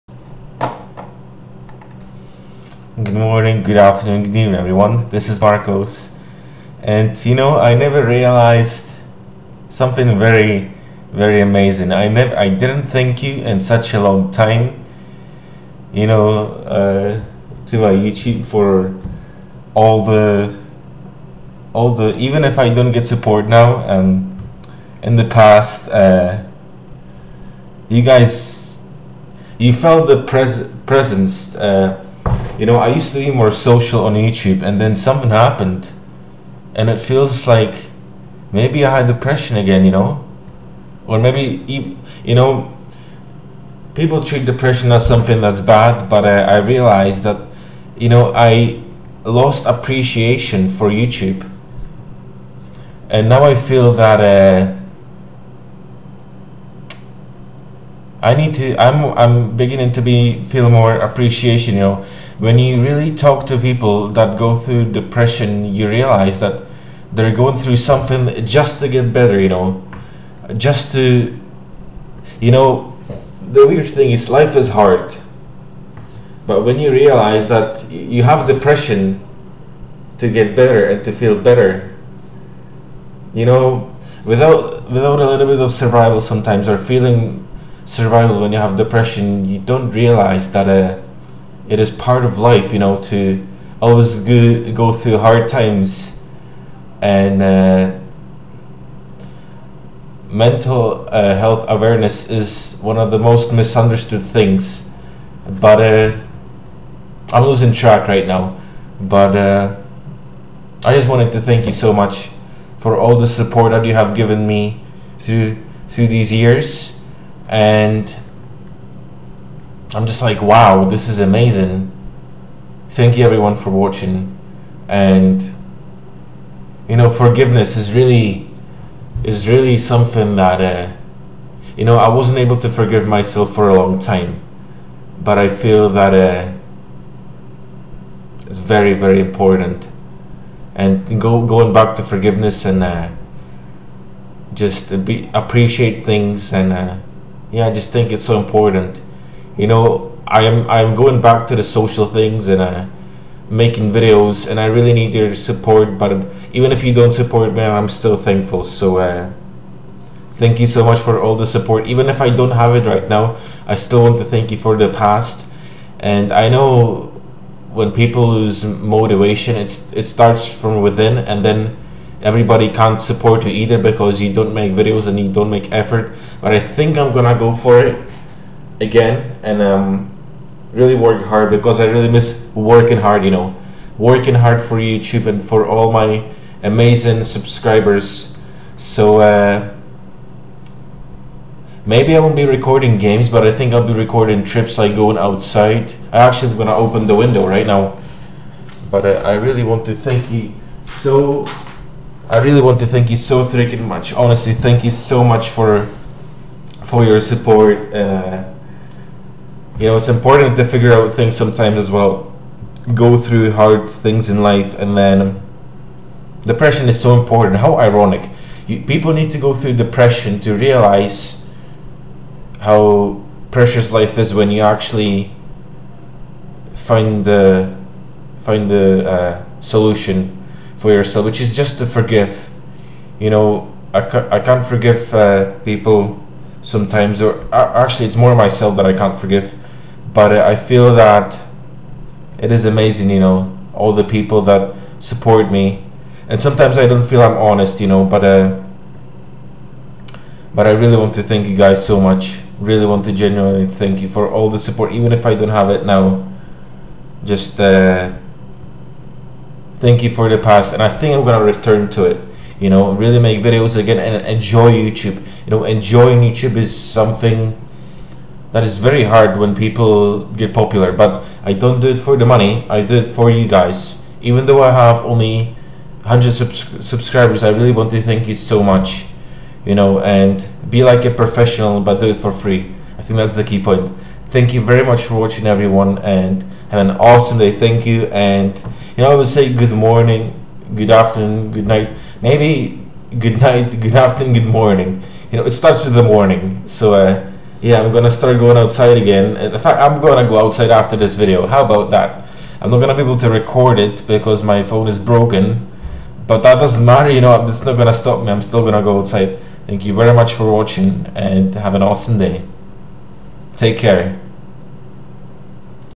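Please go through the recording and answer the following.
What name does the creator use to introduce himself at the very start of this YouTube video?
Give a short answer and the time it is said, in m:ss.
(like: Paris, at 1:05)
Marcos, at 0:05.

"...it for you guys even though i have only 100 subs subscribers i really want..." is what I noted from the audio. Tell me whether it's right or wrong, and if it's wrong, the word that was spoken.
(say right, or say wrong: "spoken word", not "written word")
right.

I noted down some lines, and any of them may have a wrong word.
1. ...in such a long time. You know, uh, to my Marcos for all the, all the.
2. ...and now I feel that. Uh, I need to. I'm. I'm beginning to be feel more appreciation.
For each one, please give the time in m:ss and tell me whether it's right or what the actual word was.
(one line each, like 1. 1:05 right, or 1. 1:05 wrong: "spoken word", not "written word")
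1. 0:13 wrong: "YouTube", not "Marcos"
2. 0:53 right.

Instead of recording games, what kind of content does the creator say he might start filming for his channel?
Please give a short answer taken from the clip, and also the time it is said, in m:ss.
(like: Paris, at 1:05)
Trips, at 3:14.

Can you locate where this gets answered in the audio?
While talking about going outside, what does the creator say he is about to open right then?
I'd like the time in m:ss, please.
3:17.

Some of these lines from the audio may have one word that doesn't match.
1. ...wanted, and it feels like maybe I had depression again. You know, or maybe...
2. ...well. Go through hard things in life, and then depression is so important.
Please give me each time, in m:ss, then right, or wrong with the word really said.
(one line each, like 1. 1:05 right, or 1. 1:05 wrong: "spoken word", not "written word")
1. 0:35 wrong: "happened", not "wanted"
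2. 3:31 right.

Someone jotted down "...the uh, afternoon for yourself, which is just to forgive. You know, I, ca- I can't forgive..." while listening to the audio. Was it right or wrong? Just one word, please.
wrong.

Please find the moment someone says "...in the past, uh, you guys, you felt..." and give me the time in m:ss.
0:25.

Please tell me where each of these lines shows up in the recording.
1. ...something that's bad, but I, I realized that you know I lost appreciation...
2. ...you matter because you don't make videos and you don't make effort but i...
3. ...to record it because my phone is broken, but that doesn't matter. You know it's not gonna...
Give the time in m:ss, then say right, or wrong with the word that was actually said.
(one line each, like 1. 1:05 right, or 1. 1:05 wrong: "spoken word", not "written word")
1. 0:45 right
2. 2:53 wrong: "either", not "matter"
3. 5:03 right.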